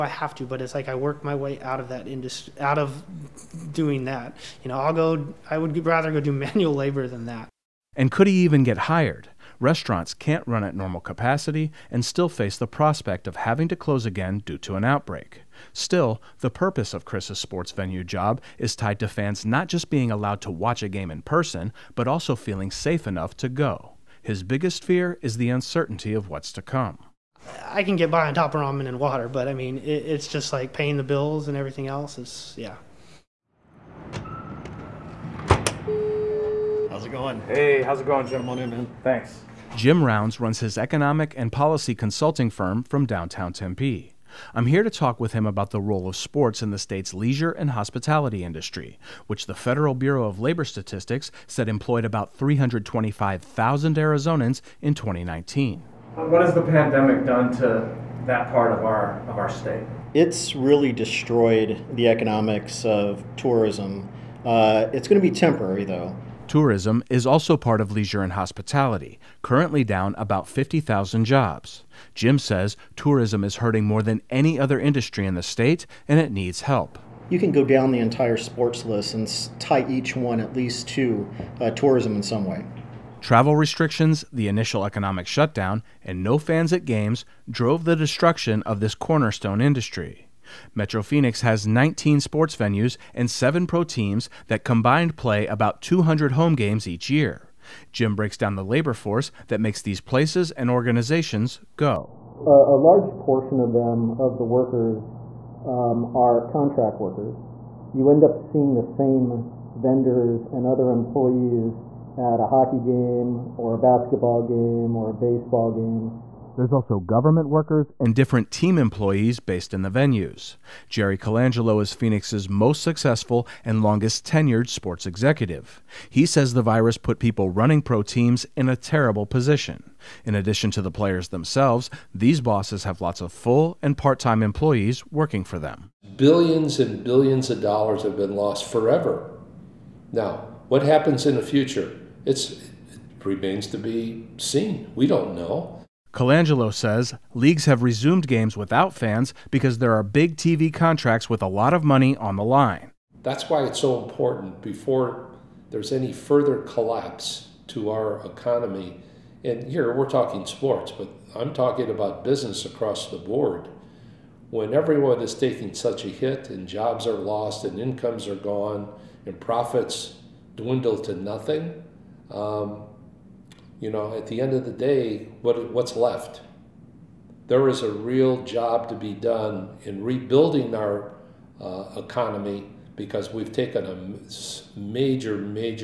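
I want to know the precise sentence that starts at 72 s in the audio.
Jim says tourism is hurting more than any other industry in the state and it needs help.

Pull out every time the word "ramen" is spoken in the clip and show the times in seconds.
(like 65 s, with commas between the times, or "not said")
28 s.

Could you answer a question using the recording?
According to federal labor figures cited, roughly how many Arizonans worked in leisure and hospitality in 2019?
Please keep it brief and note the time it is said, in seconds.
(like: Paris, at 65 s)
325,000, at 52 s.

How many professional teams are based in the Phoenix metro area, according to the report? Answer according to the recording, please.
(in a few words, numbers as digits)
7.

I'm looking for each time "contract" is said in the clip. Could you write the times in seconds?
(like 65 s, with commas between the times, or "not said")
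106 s, 150 s.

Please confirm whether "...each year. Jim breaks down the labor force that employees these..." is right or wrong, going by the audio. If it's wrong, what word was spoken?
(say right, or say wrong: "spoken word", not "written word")
wrong: "makes", not "employees".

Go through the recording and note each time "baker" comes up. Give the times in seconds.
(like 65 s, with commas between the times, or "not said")
not said.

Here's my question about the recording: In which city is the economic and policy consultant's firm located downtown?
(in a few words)
Tempe.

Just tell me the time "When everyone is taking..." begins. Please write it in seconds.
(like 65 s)
164 s.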